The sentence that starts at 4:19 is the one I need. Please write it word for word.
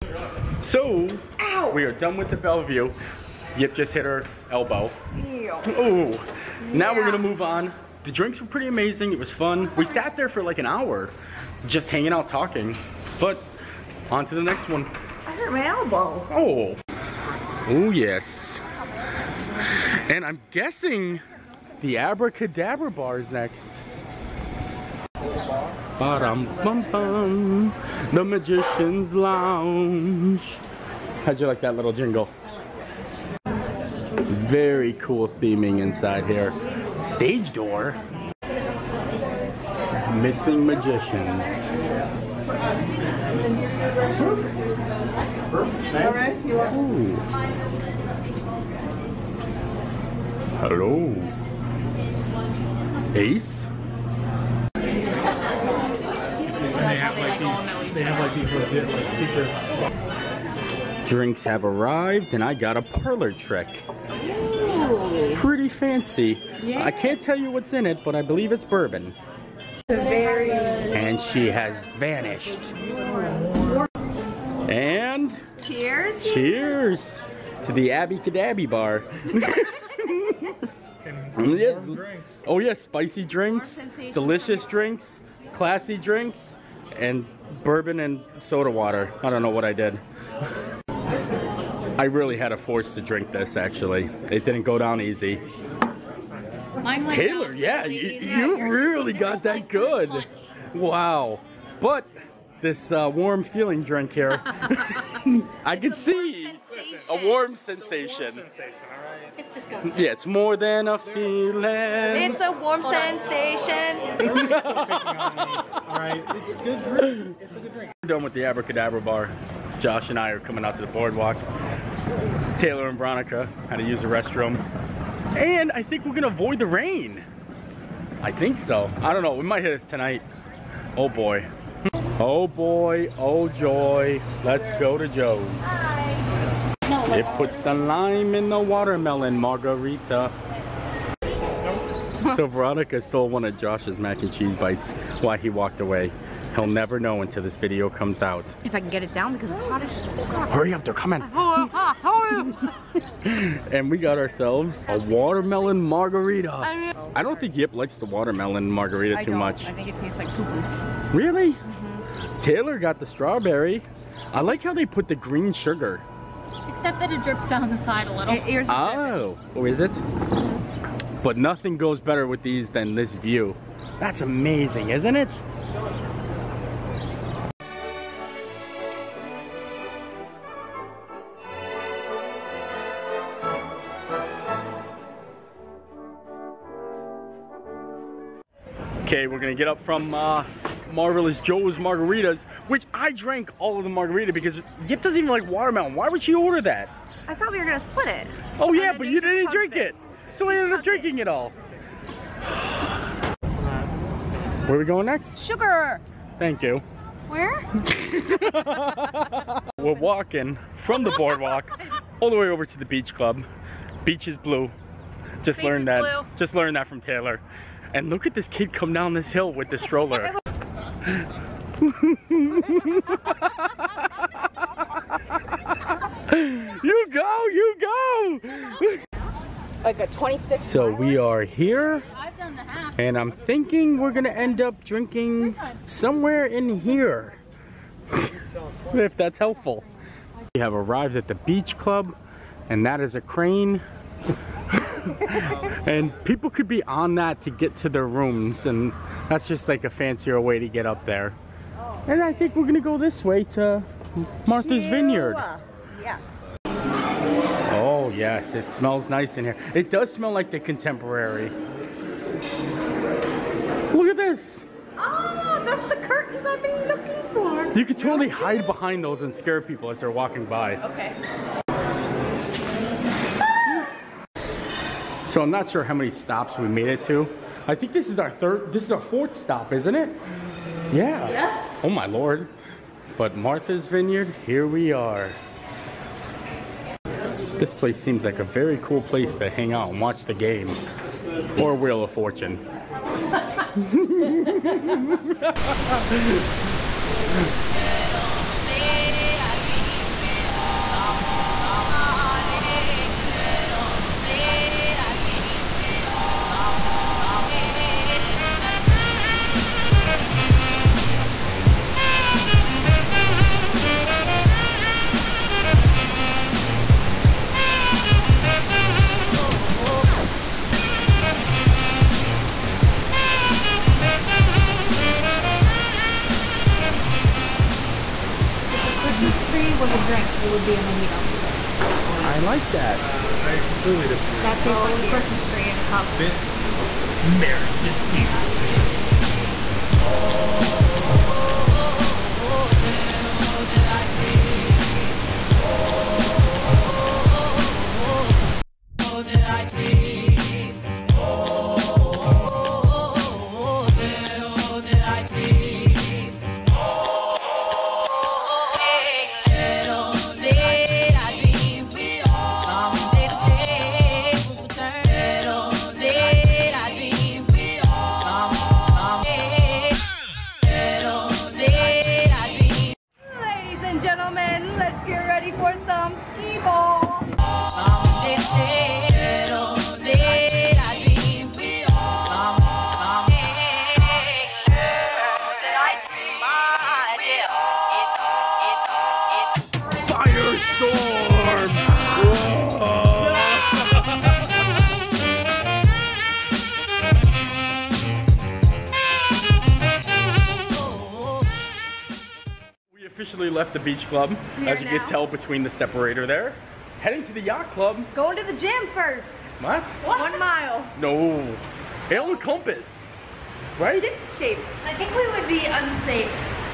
It does smell like the contemporary.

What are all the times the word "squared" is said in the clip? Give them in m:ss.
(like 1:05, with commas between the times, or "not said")
not said.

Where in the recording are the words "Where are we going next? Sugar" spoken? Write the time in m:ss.
3:24.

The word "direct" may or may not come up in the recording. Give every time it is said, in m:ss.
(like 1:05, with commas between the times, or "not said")
not said.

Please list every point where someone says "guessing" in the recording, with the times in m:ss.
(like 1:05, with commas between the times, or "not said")
0:20.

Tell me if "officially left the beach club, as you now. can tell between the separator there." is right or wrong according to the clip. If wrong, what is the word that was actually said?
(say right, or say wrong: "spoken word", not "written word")
right.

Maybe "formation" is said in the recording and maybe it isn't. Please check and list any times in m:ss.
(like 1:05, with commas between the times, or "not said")
not said.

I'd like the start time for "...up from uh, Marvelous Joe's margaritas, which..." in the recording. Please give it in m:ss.
3:09.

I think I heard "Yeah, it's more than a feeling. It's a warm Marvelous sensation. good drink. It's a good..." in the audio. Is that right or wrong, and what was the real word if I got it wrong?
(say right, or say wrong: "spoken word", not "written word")
wrong: "Hold", not "Marvelous".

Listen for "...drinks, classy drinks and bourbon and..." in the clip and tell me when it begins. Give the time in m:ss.
1:24.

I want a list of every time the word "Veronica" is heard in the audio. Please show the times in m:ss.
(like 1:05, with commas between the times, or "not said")
2:02, 2:22.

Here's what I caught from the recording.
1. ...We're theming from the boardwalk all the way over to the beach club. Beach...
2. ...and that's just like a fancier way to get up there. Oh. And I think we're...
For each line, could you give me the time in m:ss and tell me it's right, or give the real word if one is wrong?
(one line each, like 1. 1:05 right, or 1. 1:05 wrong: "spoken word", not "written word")
1. 3:29 wrong: "walking", not "theming"
2. 4:08 right.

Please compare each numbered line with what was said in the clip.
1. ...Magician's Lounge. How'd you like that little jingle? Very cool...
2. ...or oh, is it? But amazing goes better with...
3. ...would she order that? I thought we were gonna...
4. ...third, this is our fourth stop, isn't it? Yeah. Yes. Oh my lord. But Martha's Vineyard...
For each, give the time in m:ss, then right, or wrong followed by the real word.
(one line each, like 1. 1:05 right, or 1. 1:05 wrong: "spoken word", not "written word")
1. 0:28 right
2. 2:49 wrong: "nothing", not "amazing"
3. 3:16 right
4. 4:38 right.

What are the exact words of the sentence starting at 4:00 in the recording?
We have arrived at the beach club and that is a crane.